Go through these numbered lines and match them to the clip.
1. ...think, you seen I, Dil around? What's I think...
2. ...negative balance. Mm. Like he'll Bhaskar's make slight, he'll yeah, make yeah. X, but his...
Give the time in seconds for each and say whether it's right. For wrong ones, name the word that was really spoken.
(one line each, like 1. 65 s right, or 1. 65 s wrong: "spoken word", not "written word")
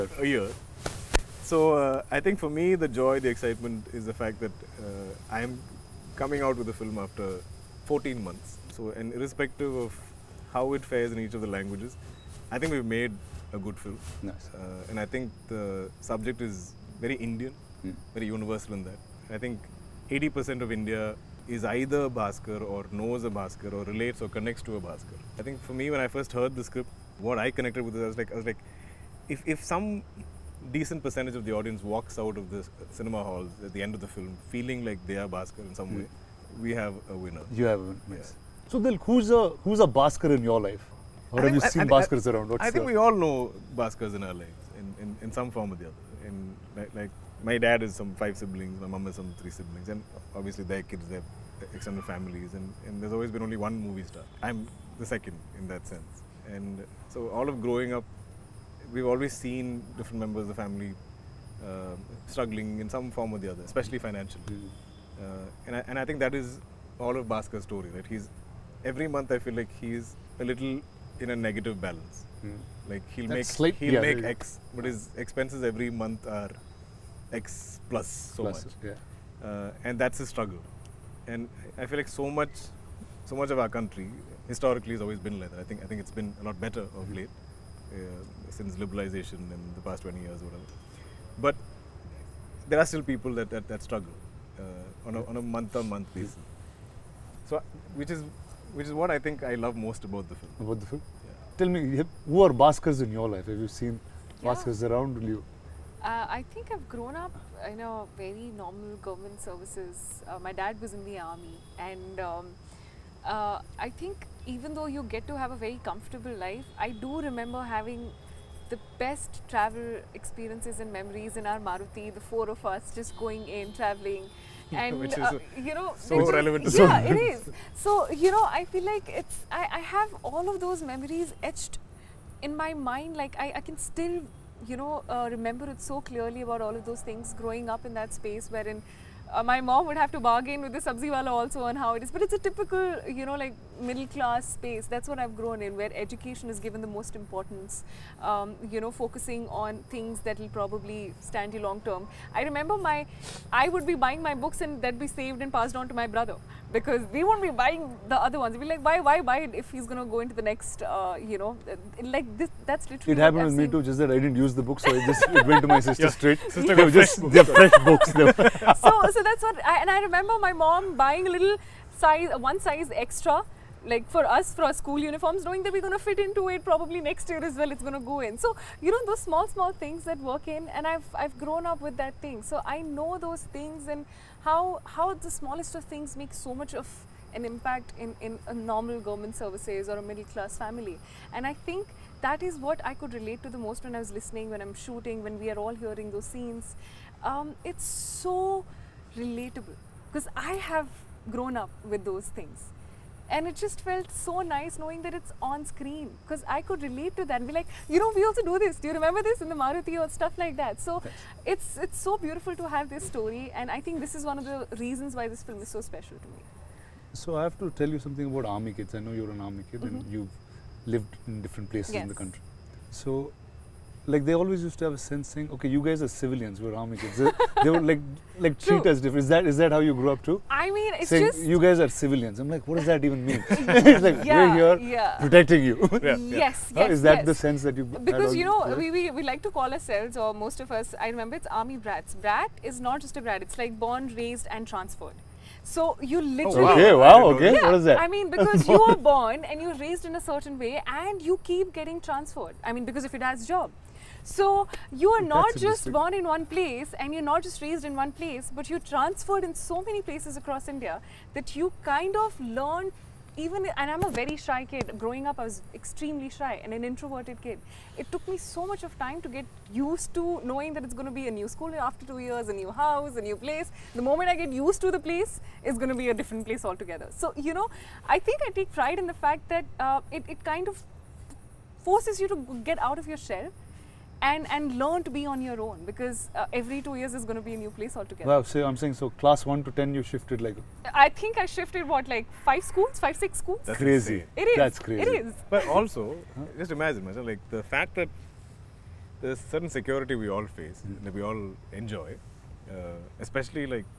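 1. 41 s wrong: "Bhaskars", not "Dil"
2. 71 s wrong: "That", not "Bhaskar".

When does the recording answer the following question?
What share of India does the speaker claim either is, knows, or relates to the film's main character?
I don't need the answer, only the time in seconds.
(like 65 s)
20 s.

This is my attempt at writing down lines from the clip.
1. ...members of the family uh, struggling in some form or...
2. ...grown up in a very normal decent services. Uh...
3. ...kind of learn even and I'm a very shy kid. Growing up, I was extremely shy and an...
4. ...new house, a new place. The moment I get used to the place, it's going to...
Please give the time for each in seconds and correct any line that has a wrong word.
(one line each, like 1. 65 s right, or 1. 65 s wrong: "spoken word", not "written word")
1. 60 s right
2. 106 s wrong: "government", not "decent"
3. 261 s right
4. 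272 s right.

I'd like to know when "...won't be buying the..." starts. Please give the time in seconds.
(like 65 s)
157 s.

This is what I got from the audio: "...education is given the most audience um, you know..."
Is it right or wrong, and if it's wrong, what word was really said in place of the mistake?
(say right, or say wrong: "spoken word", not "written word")
wrong: "importance", not "audience".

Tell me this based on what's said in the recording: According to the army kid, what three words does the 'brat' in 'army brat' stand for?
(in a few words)
Born, raised, and transferred.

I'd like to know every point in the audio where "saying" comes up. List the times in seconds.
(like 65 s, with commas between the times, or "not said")
225 s, 231 s, 288 s.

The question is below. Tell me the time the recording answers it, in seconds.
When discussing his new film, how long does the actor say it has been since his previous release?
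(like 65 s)
7 s.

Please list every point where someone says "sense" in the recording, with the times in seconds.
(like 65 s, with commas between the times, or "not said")
55 s, 224 s, 237 s.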